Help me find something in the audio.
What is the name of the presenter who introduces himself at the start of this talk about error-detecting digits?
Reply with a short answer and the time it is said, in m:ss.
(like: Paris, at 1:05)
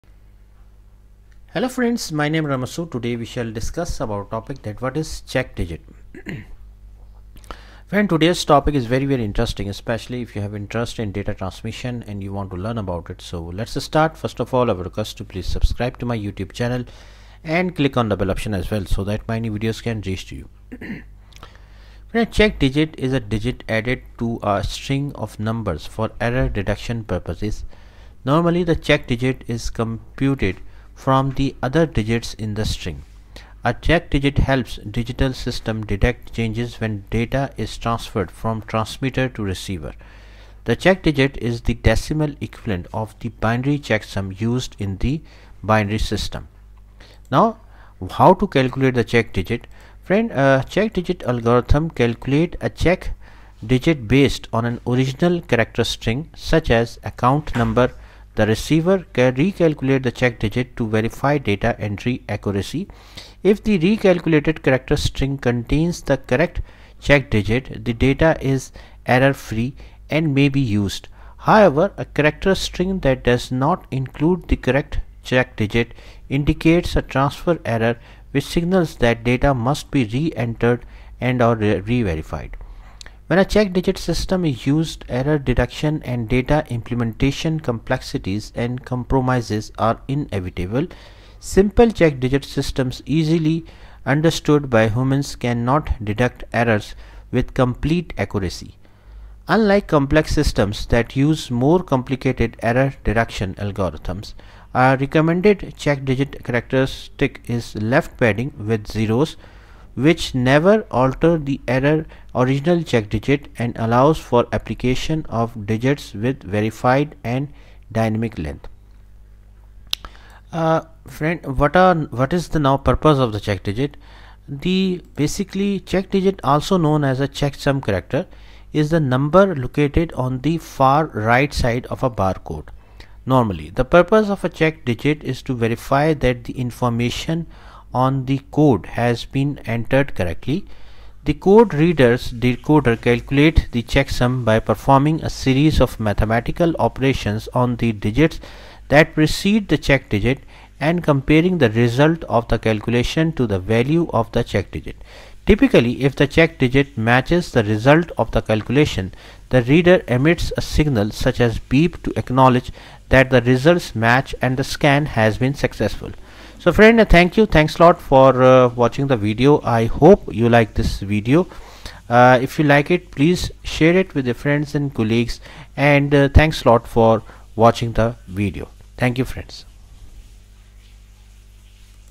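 Ramasu, at 0:02.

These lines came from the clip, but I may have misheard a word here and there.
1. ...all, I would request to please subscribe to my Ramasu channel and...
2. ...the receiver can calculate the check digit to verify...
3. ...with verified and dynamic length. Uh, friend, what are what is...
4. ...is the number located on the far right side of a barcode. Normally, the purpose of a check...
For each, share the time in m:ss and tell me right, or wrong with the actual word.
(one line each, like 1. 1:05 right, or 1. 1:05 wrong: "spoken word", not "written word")
1. 0:14 wrong: "YouTube", not "Ramasu"
2. 0:58 wrong: "recalculate", not "calculate"
3. 1:56 right
4. 2:08 right.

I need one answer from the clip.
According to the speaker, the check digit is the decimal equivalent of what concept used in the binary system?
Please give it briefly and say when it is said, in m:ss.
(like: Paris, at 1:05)
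binary checksum, at 0:43.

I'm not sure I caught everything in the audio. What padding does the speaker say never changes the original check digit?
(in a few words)
left padding with zeros.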